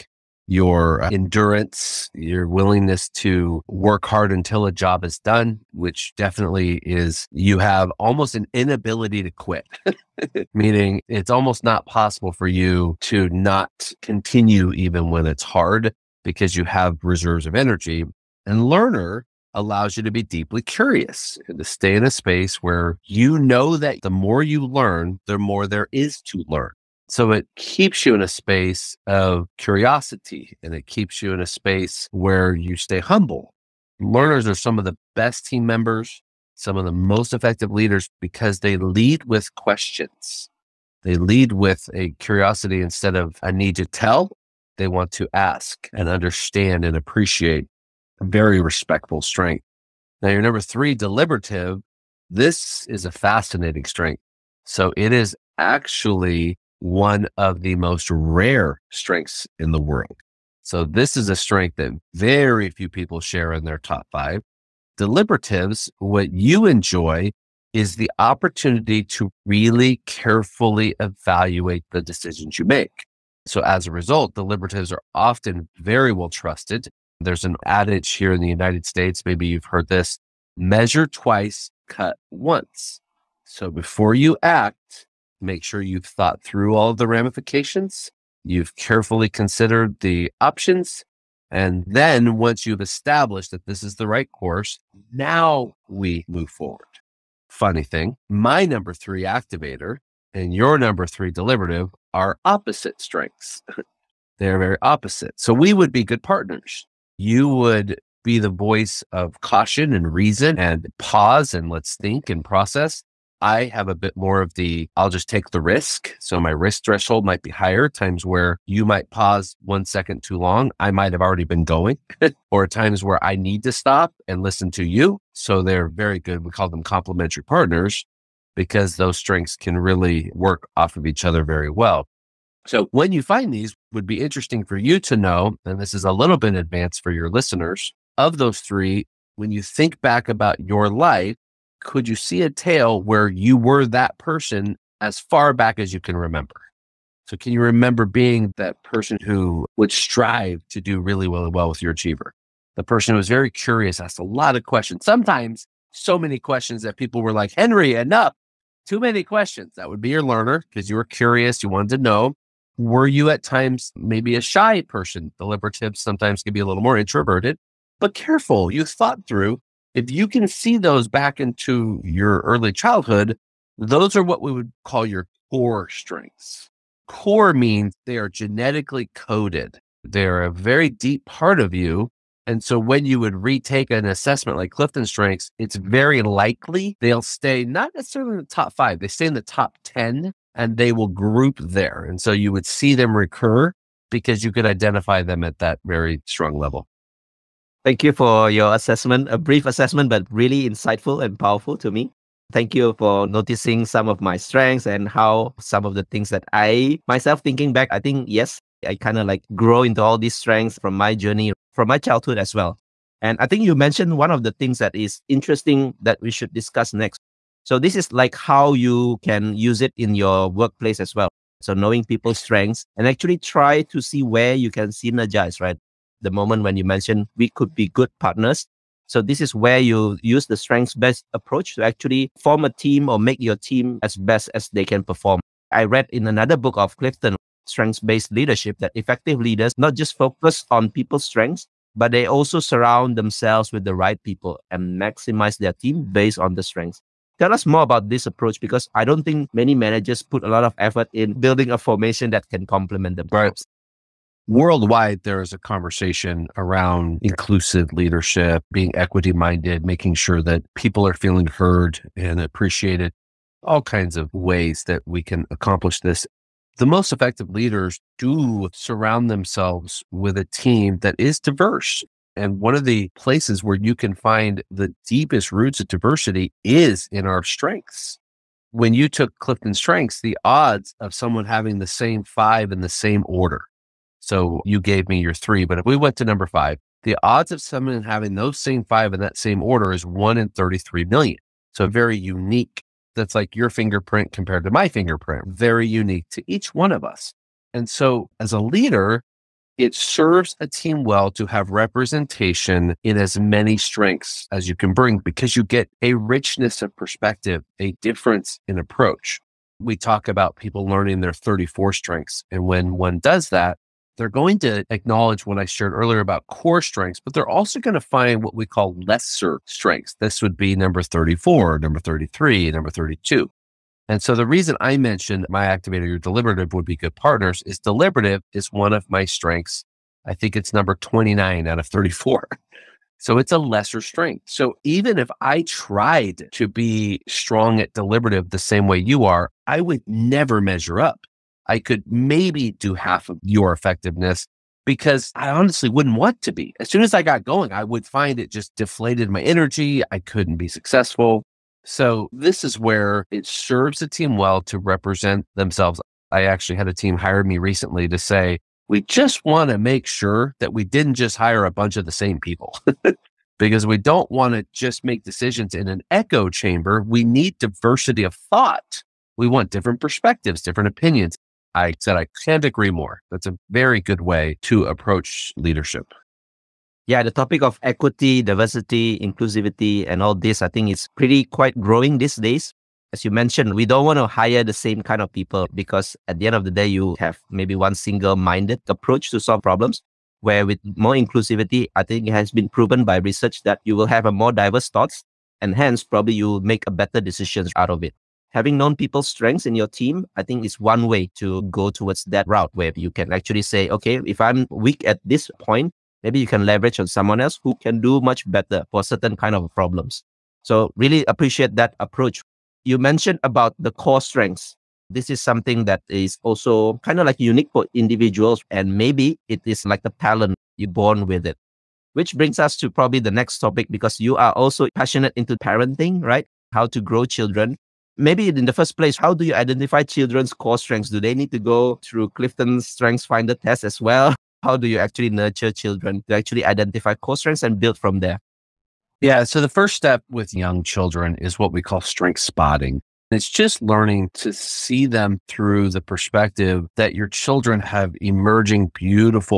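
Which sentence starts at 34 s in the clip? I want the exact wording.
Learners are some of the best team members, some of the most effective leaders because they lead with questions.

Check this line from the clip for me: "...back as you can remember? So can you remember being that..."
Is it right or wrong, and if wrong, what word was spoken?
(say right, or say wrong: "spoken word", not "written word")
right.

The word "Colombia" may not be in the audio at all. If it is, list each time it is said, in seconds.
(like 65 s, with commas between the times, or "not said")
not said.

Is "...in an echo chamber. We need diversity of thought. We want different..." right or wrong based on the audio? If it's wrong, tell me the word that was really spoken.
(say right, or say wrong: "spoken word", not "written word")
right.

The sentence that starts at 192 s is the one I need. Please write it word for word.
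And so you would see them recur because you could identify them at that very strong level.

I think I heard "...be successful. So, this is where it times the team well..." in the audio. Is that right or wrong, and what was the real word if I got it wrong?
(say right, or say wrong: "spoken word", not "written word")
wrong: "serves", not "times".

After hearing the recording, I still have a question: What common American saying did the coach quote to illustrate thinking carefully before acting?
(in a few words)
Measure twice, cut once.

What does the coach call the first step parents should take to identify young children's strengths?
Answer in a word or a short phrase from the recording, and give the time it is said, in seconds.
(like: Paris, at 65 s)
Strength spotting, at 442 s.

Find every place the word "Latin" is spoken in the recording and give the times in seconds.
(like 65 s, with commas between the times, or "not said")
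not said.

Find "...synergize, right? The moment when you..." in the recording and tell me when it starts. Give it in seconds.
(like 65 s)
224 s.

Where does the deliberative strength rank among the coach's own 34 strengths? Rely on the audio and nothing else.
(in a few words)
29.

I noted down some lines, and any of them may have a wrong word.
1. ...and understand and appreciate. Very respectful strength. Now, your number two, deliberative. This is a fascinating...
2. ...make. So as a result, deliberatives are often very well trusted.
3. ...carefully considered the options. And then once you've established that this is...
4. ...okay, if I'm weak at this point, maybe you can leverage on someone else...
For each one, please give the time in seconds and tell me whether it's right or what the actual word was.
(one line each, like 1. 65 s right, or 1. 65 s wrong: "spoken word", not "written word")
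1. 45 s wrong: "three", not "two"
2. 72 s right
3. 88 s right
4. 403 s right.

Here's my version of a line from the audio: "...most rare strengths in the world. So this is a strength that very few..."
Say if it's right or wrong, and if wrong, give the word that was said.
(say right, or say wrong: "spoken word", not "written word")
right.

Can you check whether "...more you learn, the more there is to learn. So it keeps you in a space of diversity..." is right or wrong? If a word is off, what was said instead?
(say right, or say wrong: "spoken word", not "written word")
wrong: "curiosity", not "diversity".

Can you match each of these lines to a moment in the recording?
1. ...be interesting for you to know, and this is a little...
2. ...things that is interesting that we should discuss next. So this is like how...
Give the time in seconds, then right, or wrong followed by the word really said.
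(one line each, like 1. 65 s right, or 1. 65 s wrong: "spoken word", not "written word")
1. 134 s right
2. 214 s right.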